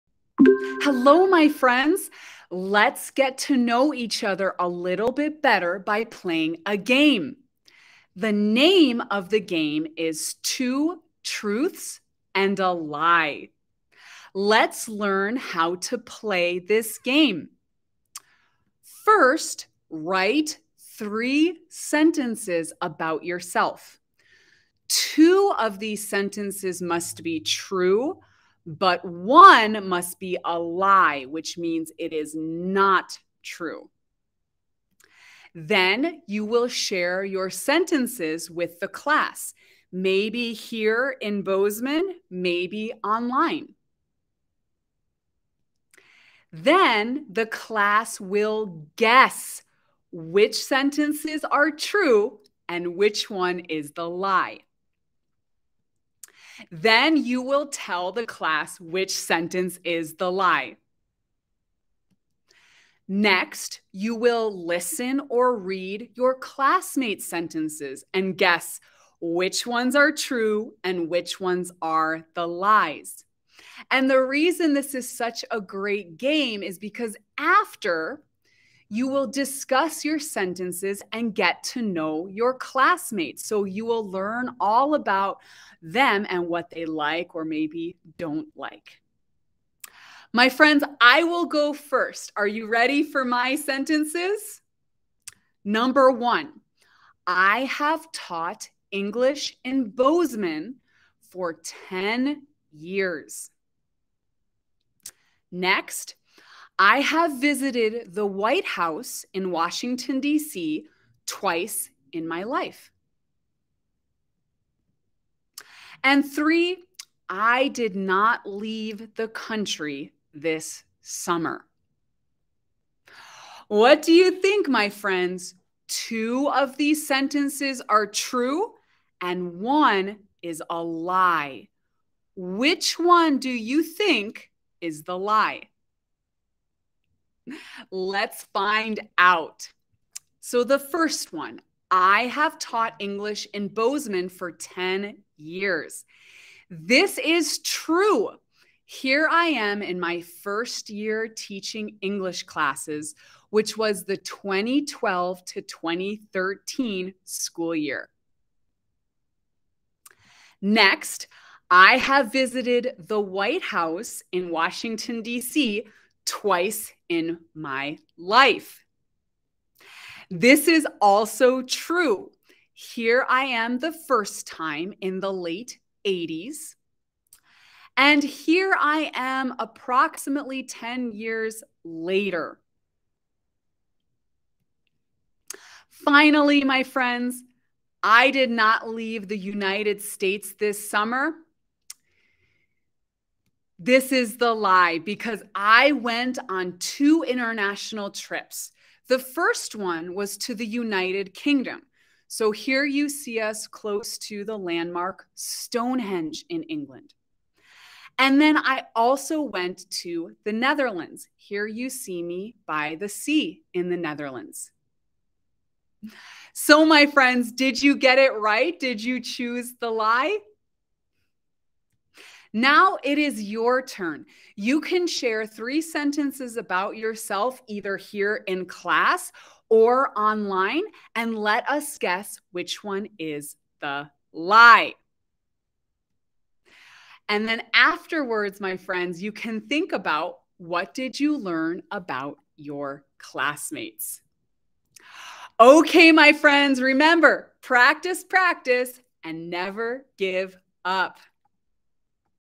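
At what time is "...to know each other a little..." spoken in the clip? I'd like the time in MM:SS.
00:03.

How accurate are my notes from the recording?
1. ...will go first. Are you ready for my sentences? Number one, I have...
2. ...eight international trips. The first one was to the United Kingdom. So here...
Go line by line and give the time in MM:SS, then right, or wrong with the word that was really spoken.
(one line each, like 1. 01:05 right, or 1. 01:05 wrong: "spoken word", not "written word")
1. 01:31 right
2. 03:16 wrong: "two", not "eight".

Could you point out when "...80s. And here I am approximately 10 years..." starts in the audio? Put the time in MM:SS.
02:56.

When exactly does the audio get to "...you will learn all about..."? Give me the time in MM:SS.
01:23.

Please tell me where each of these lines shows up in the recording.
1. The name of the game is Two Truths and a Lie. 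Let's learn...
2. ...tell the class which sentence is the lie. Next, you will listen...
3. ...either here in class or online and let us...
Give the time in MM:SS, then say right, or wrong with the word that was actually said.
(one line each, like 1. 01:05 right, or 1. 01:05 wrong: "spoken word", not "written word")
1. 00:08 right
2. 00:57 right
3. 03:47 right.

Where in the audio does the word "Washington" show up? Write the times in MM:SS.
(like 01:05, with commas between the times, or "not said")
01:49, 02:44.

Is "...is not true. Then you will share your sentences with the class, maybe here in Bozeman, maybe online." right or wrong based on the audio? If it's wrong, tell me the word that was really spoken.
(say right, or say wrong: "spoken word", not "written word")
right.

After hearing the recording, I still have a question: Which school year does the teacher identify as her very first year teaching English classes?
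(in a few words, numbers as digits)
2012 to 2013.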